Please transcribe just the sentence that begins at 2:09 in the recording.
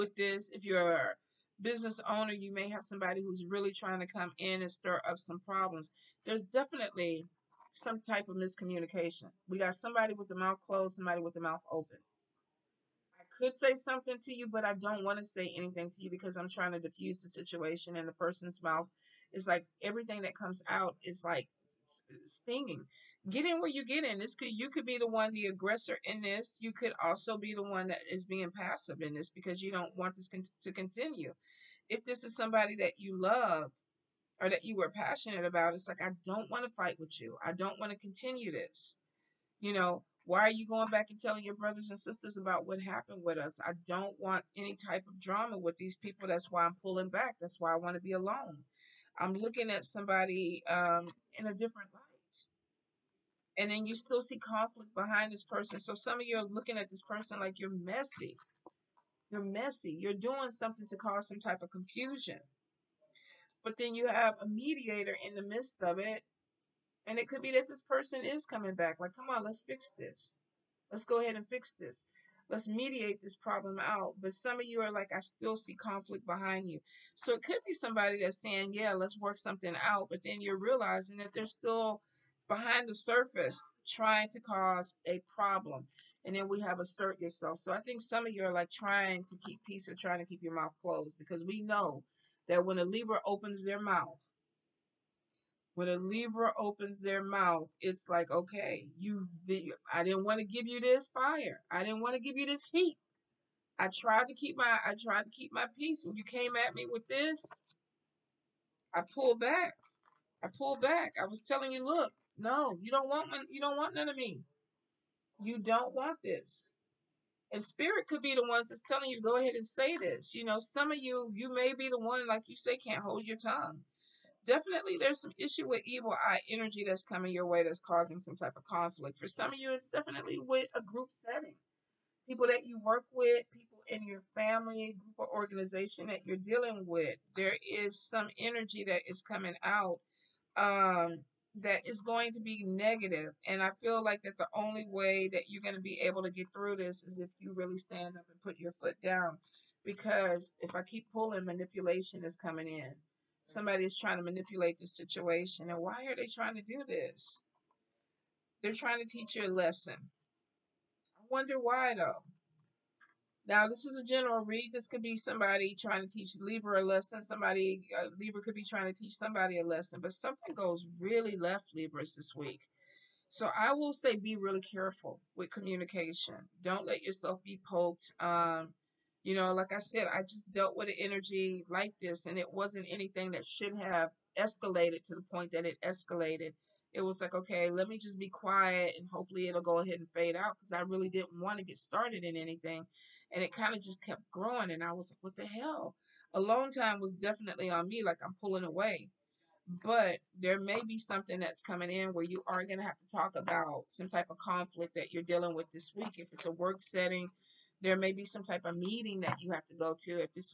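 For some of you, it's definitely with a group setting.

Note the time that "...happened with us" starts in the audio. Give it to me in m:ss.
0:42.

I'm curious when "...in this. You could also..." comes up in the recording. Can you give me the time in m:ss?
0:26.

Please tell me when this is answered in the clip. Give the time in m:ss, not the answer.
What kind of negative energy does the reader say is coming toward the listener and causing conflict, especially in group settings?
2:05.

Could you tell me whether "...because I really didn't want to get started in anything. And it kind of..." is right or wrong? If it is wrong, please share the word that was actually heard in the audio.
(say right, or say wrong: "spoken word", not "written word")
right.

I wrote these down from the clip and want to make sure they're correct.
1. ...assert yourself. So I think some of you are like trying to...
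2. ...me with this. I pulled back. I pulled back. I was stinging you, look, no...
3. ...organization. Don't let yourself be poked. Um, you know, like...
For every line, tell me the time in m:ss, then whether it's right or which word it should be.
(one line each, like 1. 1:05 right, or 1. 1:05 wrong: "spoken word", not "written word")
1. 1:26 right
2. 1:46 wrong: "telling", not "stinging"
3. 2:55 wrong: "communication", not "organization".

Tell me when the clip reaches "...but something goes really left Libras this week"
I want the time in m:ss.
2:50.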